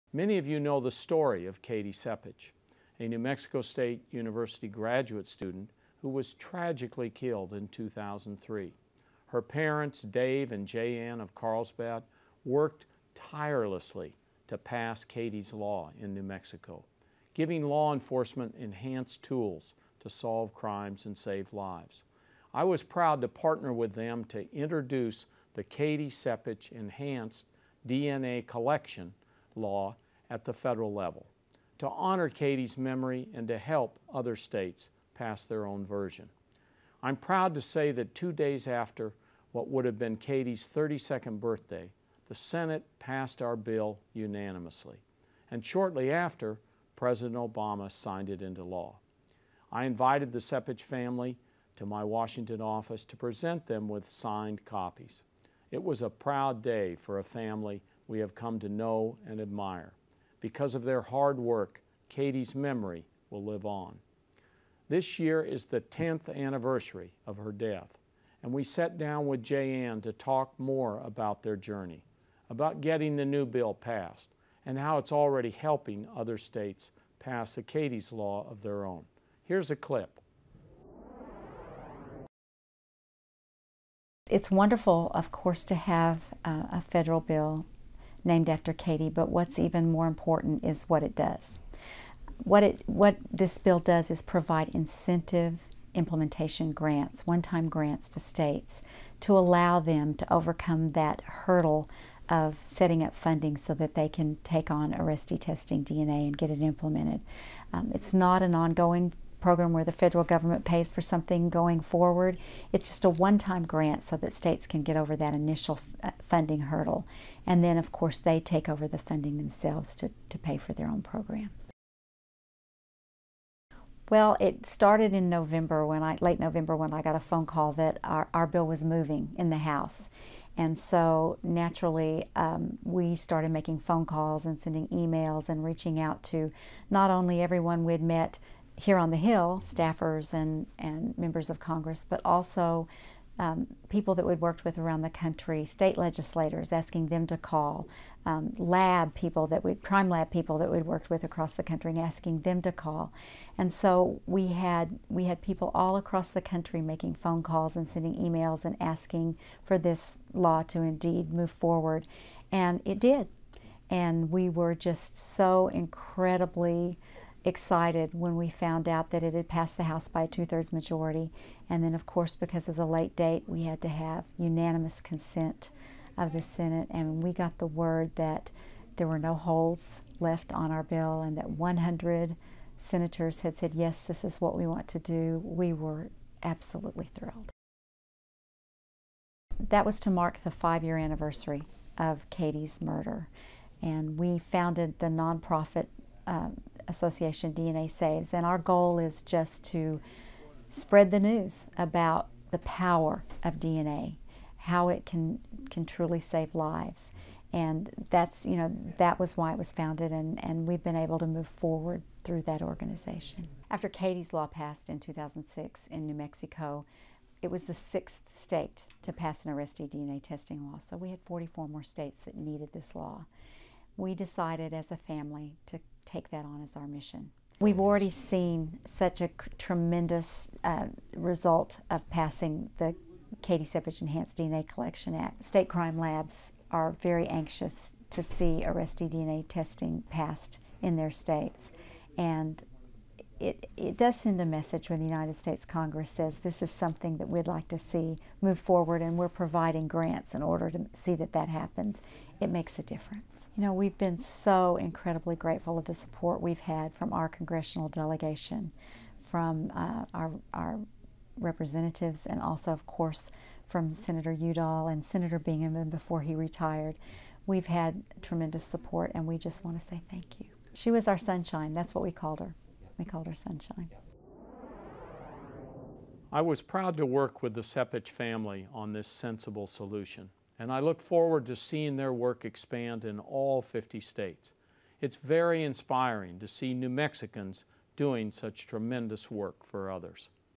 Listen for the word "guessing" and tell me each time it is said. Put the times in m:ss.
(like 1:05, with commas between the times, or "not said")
not said.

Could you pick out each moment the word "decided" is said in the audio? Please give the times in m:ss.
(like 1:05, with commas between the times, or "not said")
3:44.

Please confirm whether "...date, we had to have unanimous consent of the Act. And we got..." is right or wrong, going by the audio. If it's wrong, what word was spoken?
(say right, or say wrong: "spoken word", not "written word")
wrong: "Senate", not "Act".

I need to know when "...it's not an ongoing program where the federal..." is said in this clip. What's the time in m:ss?
1:47.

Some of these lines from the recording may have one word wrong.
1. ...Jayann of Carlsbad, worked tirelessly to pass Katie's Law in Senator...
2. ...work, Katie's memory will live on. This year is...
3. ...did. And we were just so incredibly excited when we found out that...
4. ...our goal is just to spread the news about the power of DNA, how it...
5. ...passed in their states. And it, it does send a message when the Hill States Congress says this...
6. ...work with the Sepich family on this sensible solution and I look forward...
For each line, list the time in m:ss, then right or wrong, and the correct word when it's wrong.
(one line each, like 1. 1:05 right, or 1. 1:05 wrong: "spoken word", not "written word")
1. 0:10 wrong: "New", not "Senator"
2. 1:01 right
3. 2:42 right
4. 3:18 right
5. 4:00 wrong: "United", not "Hill"
6. 4:37 right.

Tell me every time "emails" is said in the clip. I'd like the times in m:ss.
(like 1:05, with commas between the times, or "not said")
2:14, 2:38.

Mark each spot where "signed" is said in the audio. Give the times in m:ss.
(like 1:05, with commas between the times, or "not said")
0:47, 0:54.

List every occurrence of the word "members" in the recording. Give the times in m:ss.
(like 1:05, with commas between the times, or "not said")
2:21.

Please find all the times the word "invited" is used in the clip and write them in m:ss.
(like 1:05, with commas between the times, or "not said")
0:49.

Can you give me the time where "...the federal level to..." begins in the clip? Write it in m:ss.
0:30.